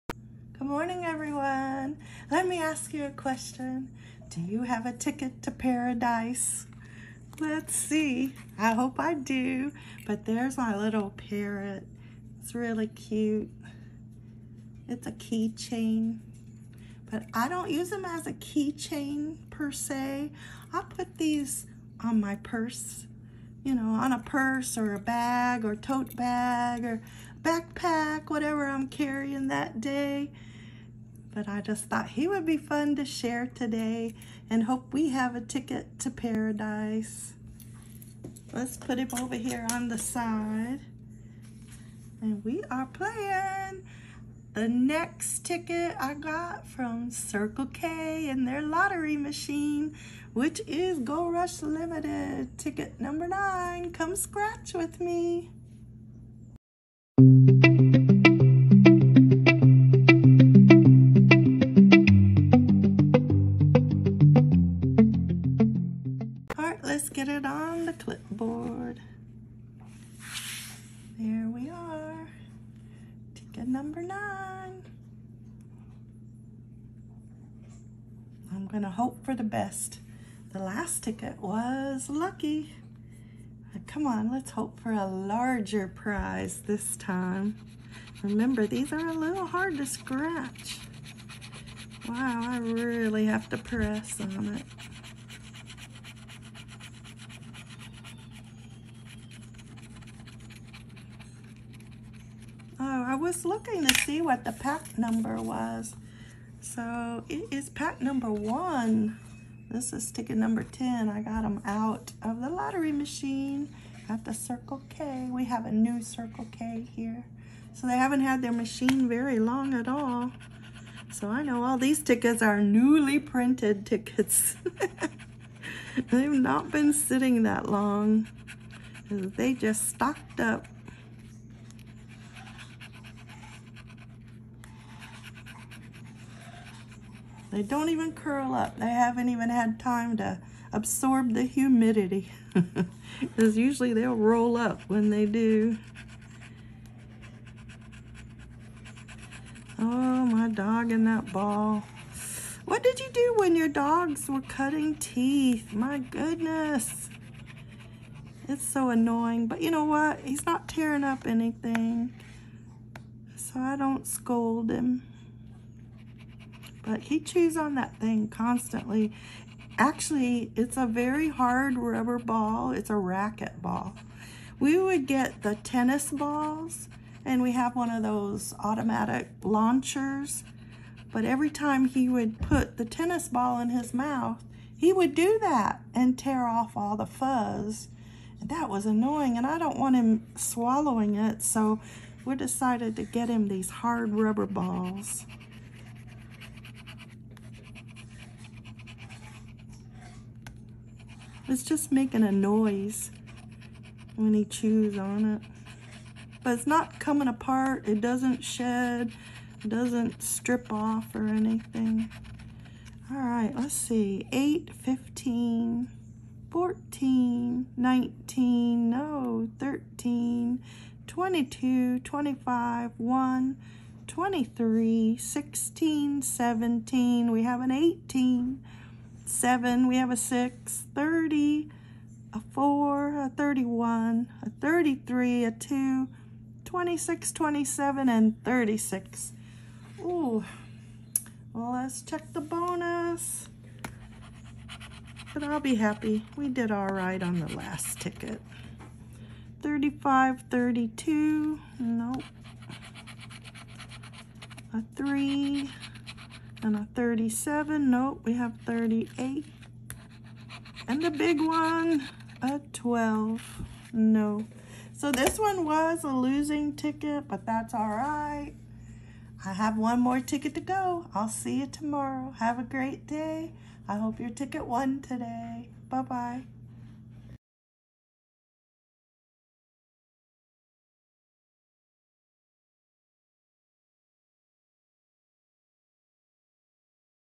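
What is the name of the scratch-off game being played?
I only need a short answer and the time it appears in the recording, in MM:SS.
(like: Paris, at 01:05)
Gold Rush Limited, at 00:50.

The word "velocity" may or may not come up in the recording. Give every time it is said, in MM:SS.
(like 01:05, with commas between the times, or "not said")
not said.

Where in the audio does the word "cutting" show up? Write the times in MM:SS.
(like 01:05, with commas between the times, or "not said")
02:34.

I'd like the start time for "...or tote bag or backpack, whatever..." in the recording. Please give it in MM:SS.
00:25.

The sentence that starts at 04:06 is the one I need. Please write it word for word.
We did all right on the last ticket.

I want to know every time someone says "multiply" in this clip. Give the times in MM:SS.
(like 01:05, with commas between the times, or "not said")
not said.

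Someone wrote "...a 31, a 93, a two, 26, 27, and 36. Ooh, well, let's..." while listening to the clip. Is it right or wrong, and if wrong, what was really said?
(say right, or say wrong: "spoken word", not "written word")
wrong: "33", not "93".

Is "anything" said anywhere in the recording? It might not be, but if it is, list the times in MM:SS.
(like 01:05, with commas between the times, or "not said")
02:41, 03:31.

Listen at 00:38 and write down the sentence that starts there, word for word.
Let's put him over here on the side.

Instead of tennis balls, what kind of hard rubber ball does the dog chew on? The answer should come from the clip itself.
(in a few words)
racket ball.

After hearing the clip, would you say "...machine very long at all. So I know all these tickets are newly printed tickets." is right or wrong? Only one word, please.
right.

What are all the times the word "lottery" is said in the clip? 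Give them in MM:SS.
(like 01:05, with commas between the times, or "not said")
00:48, 01:52.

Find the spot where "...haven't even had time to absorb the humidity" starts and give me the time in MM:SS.
02:18.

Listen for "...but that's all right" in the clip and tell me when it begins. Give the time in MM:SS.
04:27.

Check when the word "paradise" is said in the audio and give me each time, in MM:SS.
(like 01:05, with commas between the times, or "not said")
00:05, 00:36.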